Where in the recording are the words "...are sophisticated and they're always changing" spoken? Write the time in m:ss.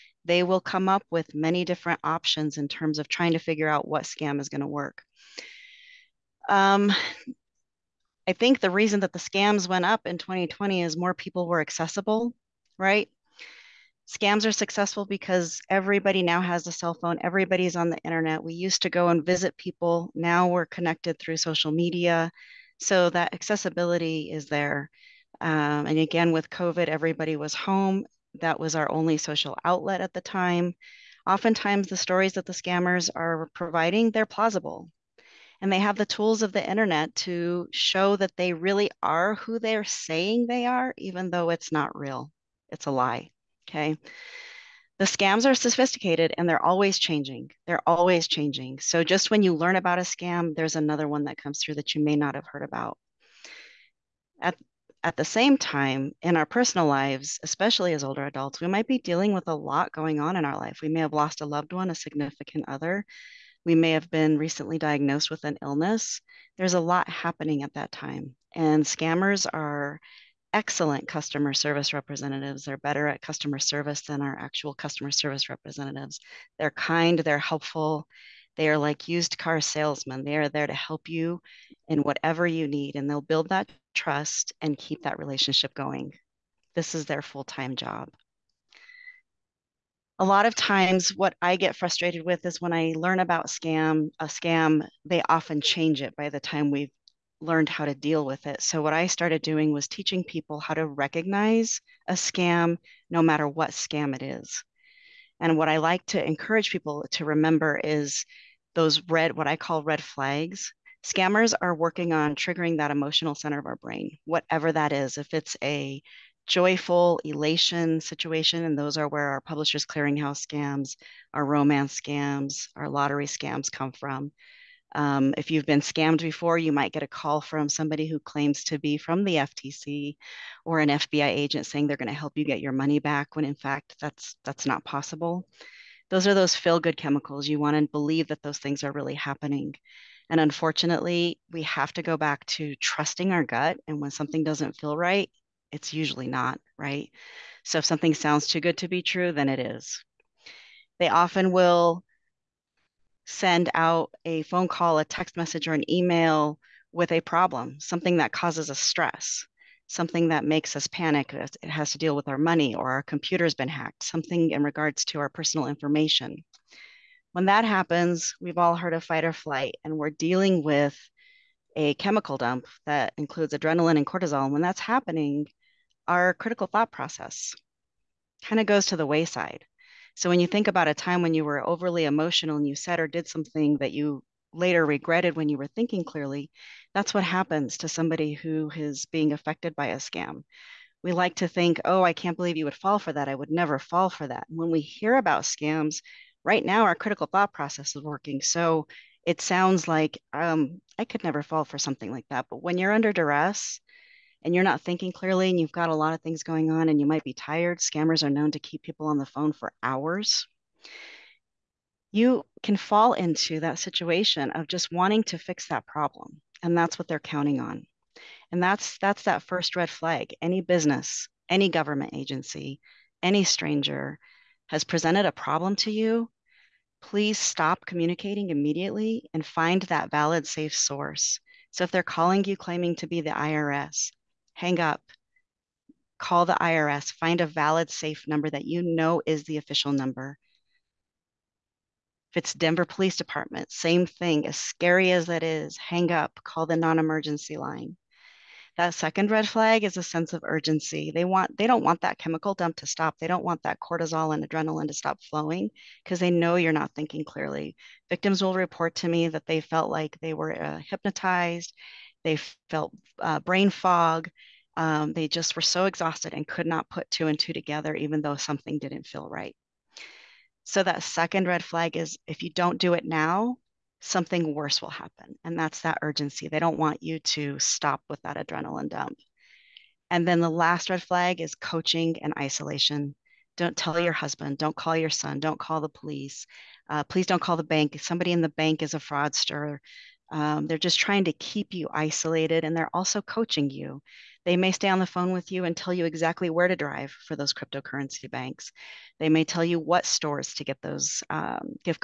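0:45.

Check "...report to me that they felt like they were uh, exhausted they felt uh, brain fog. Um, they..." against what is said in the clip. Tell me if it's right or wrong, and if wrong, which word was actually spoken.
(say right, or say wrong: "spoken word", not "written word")
wrong: "hypnotized", not "exhausted".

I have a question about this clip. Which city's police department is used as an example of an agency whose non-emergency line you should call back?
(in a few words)
Denver.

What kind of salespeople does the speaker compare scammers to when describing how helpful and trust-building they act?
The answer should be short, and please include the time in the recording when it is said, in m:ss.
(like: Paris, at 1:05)
used car salesmen, at 1:19.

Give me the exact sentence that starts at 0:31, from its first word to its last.
Oftentimes, the stories that the scammers are providing, they're plausible.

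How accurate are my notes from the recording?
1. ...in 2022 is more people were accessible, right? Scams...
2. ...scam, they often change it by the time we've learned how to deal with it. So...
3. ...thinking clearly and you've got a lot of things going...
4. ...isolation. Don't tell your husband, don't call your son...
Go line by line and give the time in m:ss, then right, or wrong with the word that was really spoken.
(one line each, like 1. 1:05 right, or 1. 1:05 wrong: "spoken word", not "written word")
1. 0:10 wrong: "2020", not "2022"
2. 1:34 right
3. 3:24 right
4. 4:42 right.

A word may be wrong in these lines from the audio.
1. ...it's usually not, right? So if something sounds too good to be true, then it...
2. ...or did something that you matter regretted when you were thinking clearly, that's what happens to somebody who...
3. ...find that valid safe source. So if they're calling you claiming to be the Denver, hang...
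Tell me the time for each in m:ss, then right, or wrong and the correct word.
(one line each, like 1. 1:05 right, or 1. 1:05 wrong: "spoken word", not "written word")
1. 2:25 right
2. 3:03 wrong: "later", not "matter"
3. 3:49 wrong: "IRS", not "Denver".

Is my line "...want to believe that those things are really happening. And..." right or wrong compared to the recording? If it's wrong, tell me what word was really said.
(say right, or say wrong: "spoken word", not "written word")
right.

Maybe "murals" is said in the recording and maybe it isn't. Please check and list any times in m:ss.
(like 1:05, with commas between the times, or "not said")
not said.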